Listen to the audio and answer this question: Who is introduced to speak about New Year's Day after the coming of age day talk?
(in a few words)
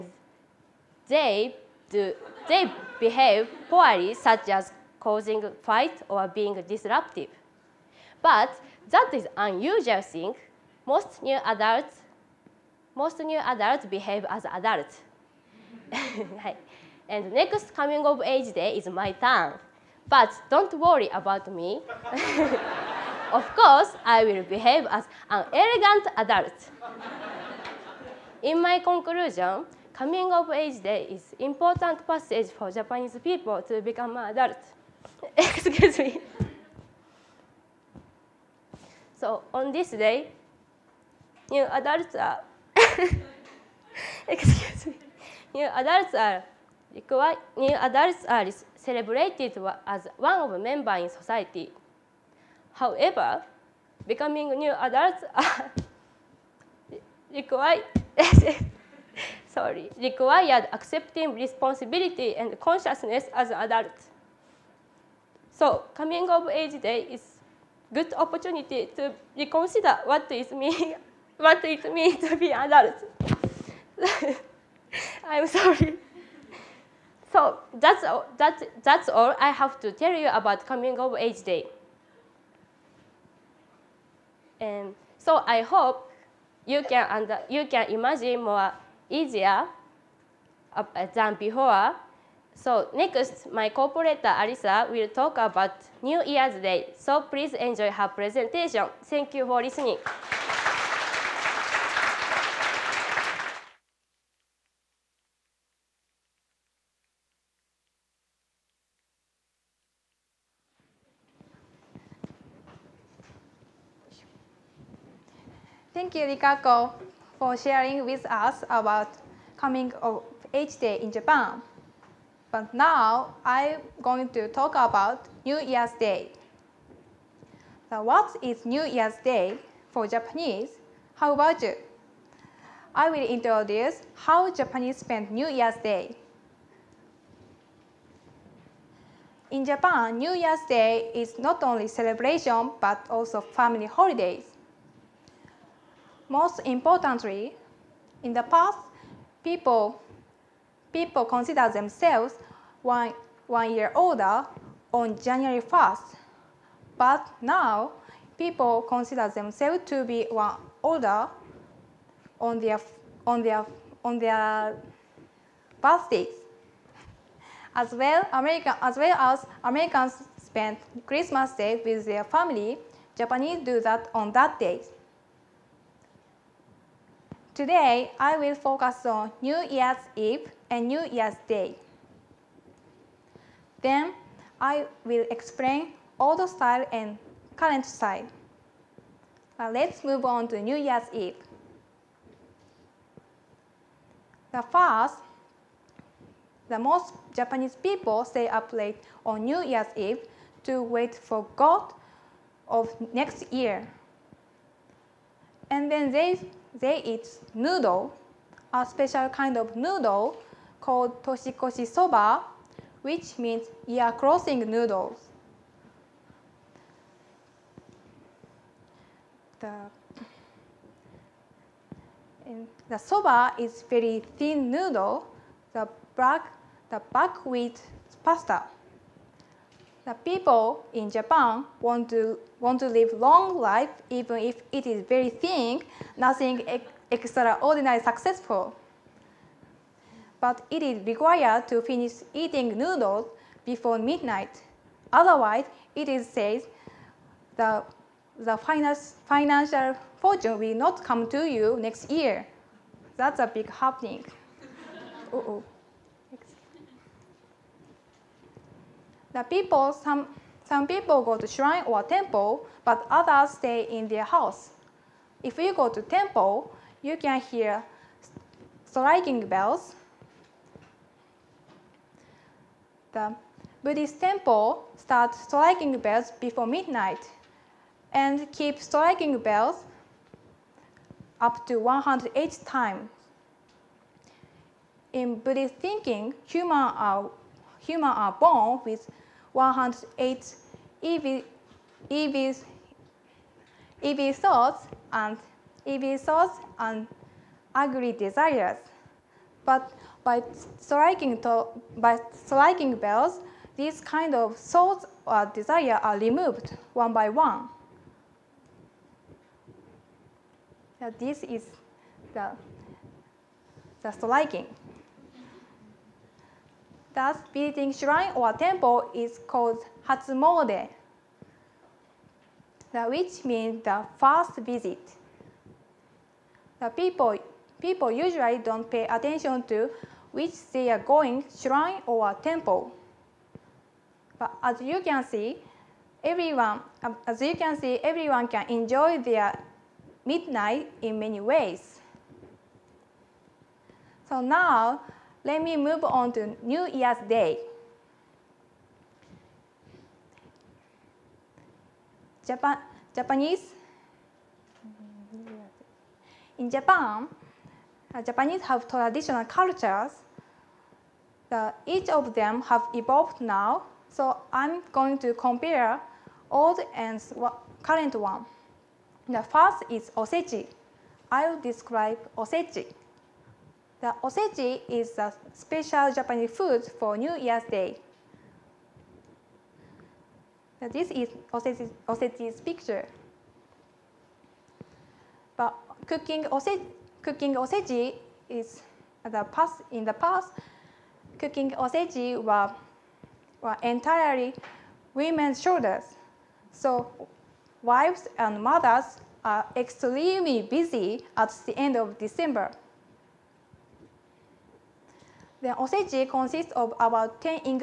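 Alisa.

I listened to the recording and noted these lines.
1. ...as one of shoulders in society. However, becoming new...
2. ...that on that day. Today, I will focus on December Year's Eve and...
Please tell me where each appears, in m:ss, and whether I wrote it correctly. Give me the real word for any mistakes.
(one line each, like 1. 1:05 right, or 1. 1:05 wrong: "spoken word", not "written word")
1. 0:49 wrong: "members", not "shoulders"
2. 2:53 wrong: "New", not "December".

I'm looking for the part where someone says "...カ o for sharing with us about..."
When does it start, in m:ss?
1:56.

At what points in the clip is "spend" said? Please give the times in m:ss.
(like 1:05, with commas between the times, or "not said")
2:14, 2:50.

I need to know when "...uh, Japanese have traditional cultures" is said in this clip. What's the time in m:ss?
5:58.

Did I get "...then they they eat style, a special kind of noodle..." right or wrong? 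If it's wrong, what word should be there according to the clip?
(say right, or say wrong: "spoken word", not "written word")
wrong: "noodle", not "style".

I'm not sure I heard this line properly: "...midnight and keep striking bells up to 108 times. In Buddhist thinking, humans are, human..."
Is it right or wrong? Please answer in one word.
right.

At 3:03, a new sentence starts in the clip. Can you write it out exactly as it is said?
Then, I will explain old style and current style.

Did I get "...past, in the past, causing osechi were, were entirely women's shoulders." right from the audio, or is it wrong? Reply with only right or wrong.
wrong.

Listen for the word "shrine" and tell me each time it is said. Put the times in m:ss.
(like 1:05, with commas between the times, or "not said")
4:21, 5:17, 5:31.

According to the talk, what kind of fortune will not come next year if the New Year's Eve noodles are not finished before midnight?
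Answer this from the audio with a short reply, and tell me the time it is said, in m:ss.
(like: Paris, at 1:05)
financial fortune, at 4:09.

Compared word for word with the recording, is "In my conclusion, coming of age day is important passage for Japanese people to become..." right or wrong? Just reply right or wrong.
right.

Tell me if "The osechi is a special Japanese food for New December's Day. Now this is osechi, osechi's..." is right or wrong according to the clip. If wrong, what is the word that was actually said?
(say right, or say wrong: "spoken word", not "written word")
wrong: "Year", not "December".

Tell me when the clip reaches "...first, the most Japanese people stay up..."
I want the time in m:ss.
3:14.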